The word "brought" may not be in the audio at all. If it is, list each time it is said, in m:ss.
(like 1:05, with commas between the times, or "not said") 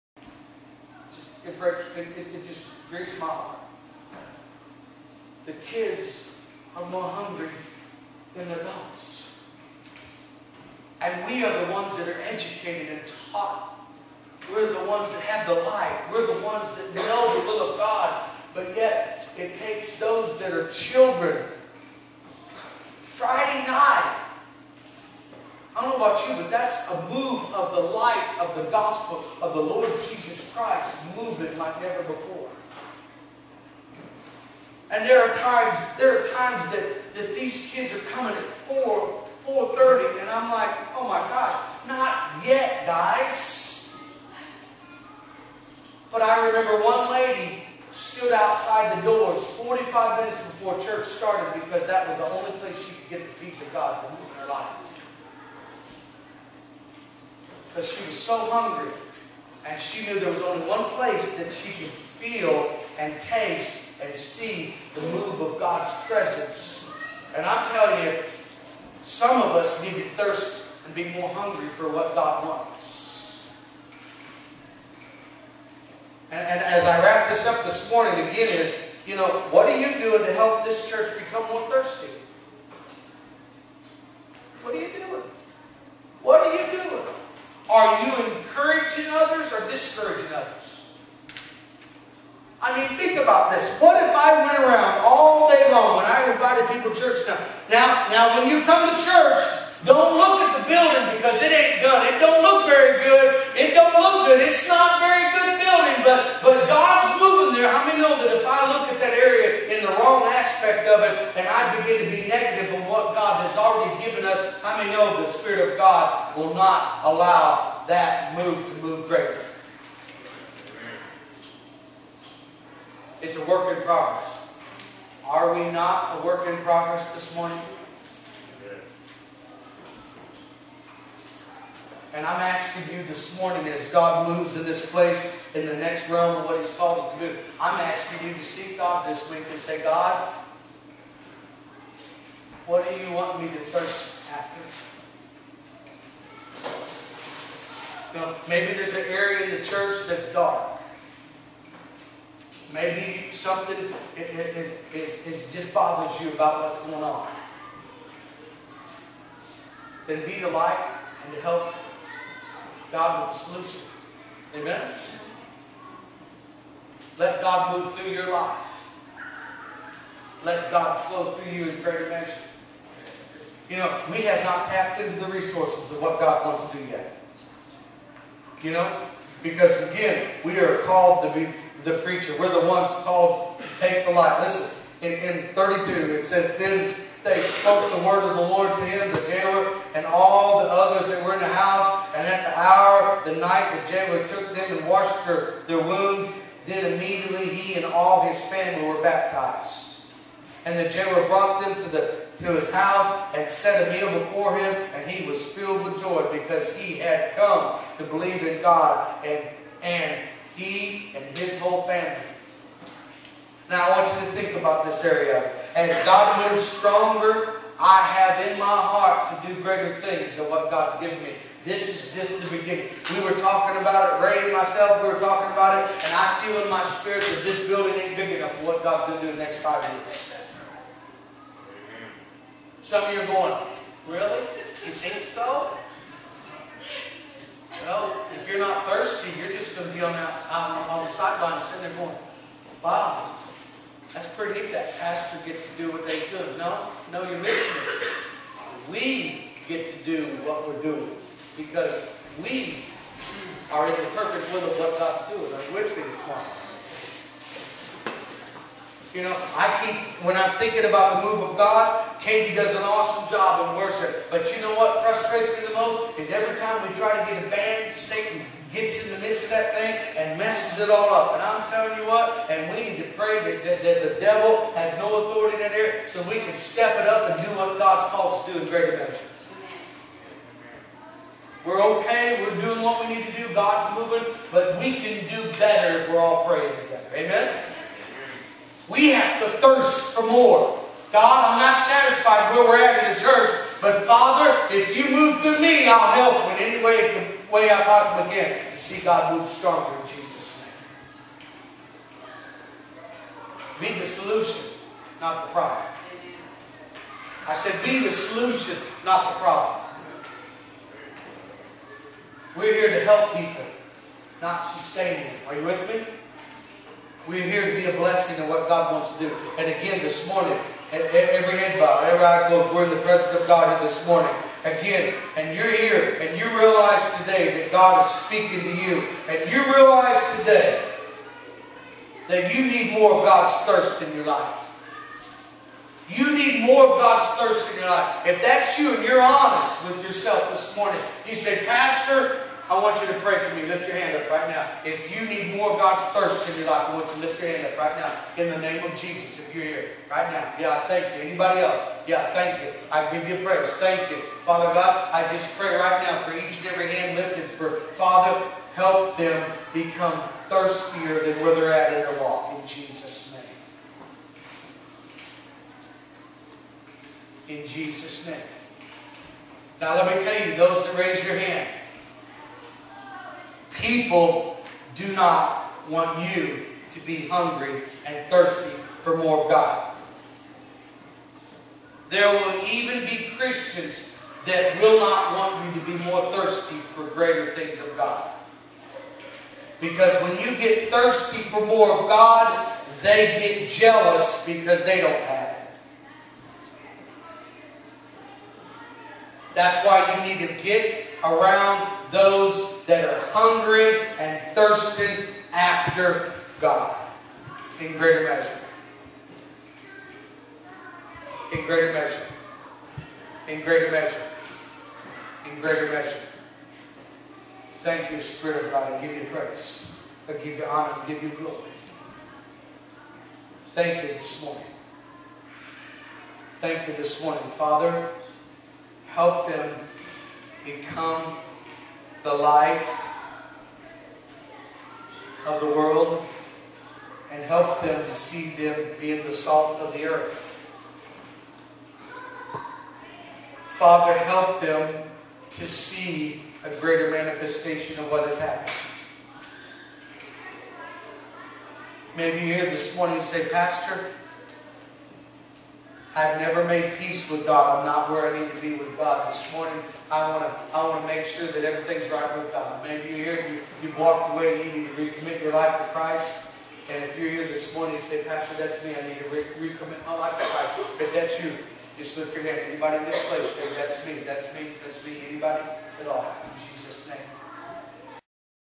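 3:21.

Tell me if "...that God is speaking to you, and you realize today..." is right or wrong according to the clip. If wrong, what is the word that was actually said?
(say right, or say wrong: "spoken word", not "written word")
right.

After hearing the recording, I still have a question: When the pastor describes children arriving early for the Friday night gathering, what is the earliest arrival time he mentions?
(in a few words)
4.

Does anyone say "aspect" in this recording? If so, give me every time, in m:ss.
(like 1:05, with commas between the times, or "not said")
1:50.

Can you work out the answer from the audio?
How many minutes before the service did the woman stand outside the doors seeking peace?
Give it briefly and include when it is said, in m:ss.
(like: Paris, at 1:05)
45, at 0:49.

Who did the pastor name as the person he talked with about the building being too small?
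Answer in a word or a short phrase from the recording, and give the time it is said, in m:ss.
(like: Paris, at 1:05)
Ray, at 3:44.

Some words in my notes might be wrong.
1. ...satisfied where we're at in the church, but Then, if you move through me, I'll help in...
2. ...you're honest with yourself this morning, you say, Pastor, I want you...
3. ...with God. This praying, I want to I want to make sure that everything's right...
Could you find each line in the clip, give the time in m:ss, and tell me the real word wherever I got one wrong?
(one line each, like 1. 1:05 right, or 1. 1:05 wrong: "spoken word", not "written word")
1. 4:51 wrong: "Father", not "Then"
2. 5:39 right
3. 7:38 wrong: "morning", not "praying".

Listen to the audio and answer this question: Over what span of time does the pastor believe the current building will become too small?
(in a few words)
five years.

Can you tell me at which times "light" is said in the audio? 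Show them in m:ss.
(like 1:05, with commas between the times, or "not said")
0:15, 0:27, 2:40, 3:04, 7:12.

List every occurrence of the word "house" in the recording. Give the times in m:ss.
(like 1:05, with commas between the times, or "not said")
3:11, 3:22.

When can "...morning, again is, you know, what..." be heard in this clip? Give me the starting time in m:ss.
1:17.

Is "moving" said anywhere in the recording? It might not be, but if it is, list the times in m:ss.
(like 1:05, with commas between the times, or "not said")
0:31, 1:47, 4:43.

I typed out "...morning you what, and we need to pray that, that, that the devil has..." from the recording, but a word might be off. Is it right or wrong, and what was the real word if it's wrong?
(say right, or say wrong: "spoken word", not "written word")
wrong: "telling", not "morning".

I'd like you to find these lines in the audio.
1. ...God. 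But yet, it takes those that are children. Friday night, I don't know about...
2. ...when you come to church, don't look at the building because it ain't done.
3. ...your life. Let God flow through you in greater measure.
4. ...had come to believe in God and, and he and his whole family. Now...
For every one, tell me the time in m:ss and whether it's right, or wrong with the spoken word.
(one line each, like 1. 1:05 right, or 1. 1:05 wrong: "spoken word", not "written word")
1. 0:17 right
2. 1:38 right
3. 2:48 right
4. 3:26 right.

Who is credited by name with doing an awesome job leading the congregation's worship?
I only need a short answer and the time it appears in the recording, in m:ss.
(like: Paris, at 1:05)
Katie, at 4:22.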